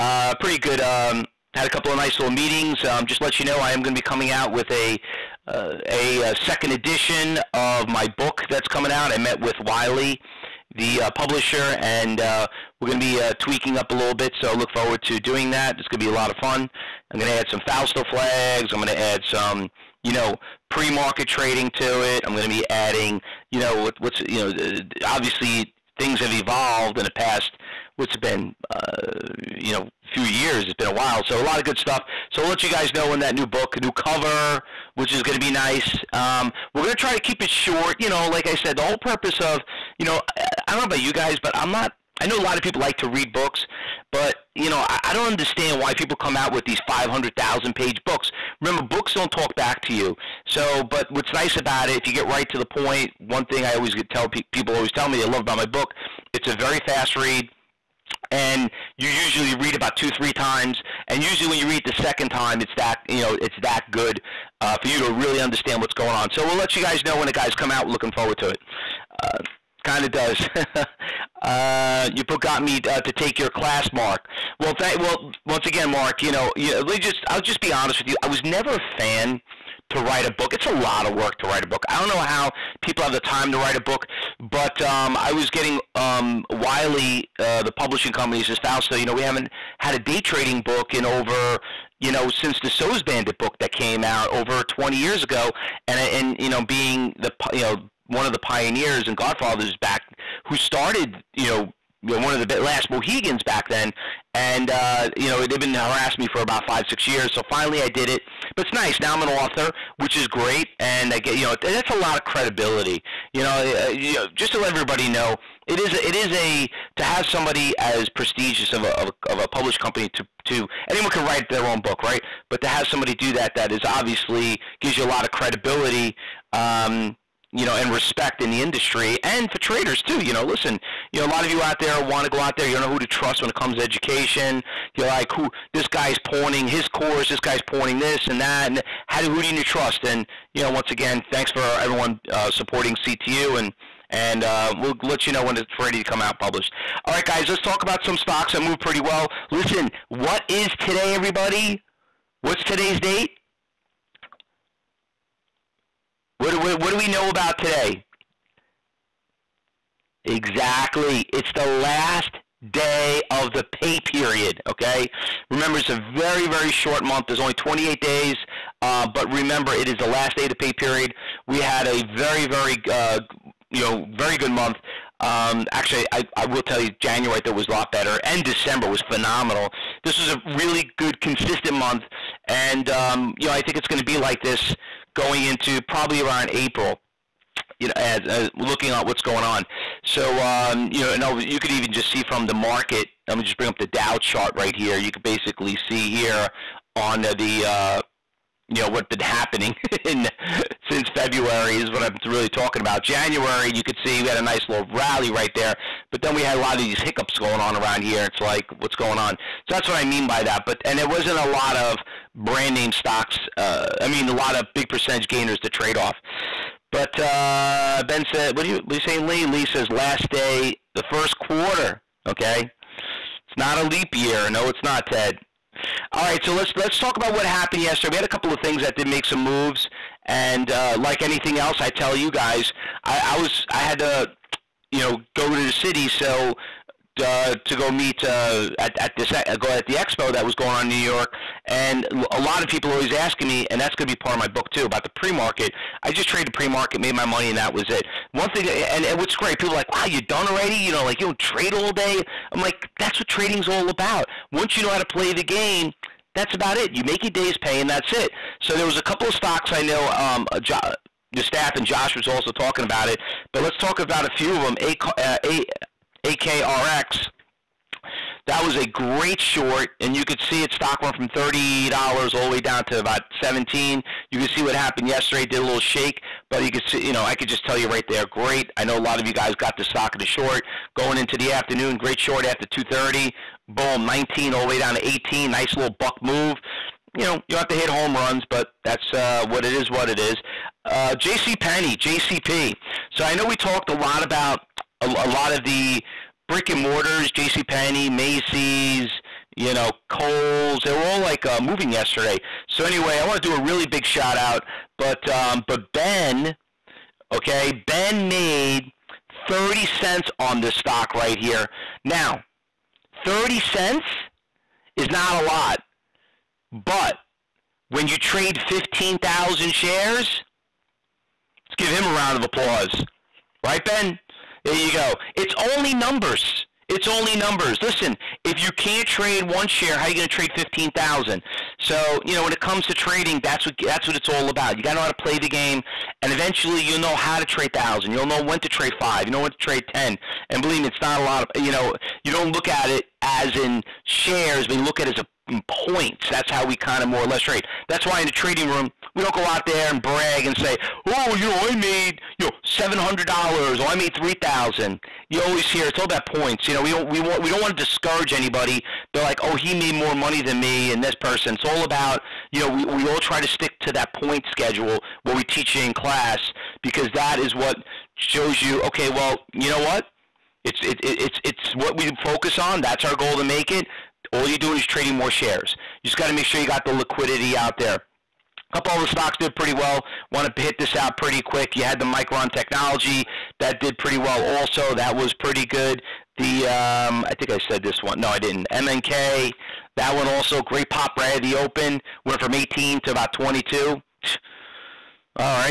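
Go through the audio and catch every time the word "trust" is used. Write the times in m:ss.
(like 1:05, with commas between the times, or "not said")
2:13, 2:19.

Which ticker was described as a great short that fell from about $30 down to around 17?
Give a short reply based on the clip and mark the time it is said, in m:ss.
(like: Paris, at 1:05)
AKRX, at 4:26.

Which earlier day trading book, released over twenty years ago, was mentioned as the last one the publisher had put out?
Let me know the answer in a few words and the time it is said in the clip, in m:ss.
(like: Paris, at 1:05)
SOES Bandit, at 1:32.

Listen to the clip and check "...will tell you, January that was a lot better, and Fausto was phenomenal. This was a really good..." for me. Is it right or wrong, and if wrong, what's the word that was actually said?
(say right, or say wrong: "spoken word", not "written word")
wrong: "December", not "Fausto".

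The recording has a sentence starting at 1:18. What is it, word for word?
I was never a fan to write a book.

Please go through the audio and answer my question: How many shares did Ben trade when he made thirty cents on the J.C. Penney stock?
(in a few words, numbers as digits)
15,000.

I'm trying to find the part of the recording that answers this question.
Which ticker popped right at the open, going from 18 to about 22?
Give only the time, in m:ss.
6:28.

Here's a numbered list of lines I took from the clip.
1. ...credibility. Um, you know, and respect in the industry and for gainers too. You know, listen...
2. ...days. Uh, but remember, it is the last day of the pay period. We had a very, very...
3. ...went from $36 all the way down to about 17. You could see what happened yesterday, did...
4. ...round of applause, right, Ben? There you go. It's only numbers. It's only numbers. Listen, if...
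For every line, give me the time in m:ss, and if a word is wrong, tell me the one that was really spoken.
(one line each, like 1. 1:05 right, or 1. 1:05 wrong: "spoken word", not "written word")
1. 2:05 wrong: "traders", not "gainers"
2. 2:47 right
3. 4:31 wrong: "30", not "36"
4. 5:22 right.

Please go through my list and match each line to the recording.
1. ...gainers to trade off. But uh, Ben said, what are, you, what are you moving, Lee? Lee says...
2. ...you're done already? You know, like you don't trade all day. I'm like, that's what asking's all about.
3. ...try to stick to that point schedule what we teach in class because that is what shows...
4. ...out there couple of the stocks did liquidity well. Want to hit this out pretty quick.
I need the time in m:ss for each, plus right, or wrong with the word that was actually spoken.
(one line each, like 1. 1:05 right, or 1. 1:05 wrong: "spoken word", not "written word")
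1. 3:35 wrong: "saying", not "moving"
2. 4:10 wrong: "trading", not "asking"
3. 6:03 right
4. 6:17 wrong: "pretty", not "liquidity".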